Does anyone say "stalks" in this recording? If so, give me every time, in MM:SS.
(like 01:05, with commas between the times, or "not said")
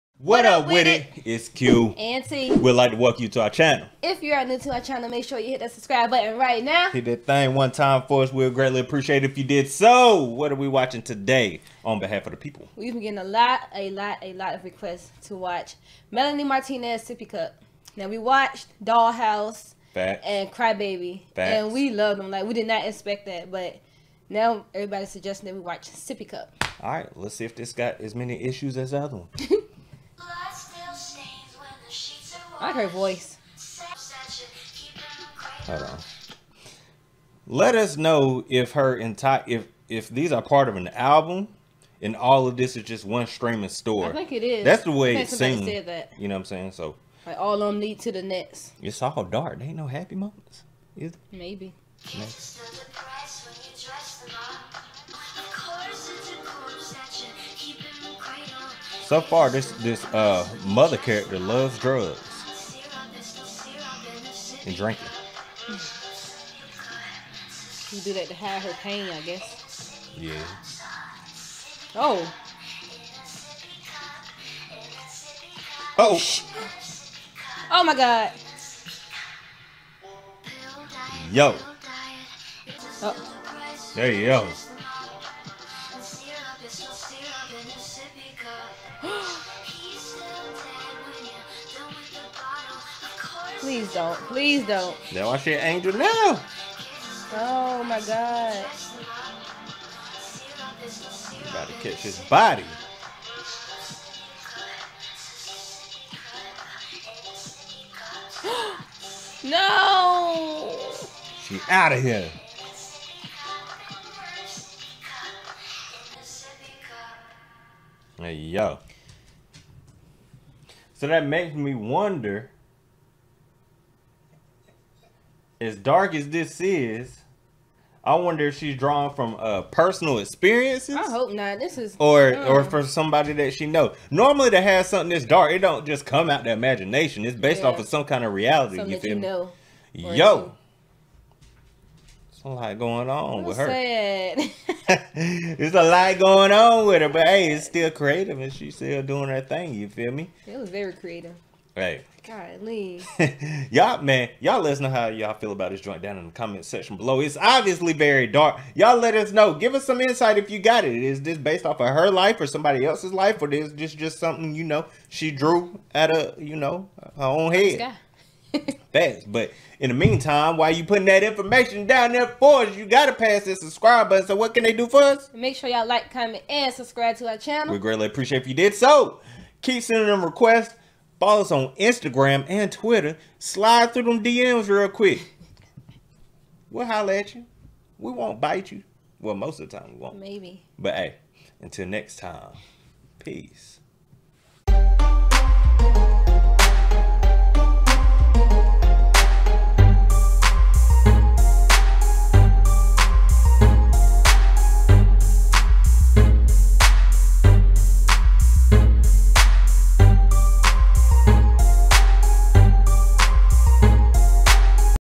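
not said.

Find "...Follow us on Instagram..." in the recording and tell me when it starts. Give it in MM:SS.
03:01.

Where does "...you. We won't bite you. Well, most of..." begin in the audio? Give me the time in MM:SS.
03:07.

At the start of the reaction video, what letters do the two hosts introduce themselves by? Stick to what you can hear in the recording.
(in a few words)
Q and T.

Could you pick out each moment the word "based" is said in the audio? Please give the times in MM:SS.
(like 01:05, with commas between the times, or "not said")
02:17, 02:41.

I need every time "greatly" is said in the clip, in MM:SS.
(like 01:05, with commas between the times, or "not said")
00:08, 02:57.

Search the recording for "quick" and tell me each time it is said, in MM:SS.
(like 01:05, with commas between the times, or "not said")
03:04.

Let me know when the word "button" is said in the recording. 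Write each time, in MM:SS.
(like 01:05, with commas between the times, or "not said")
00:06, 02:54.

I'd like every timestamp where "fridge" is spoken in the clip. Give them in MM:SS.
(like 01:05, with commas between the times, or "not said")
not said.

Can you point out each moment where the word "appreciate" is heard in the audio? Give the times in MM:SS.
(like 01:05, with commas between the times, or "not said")
00:08, 02:58.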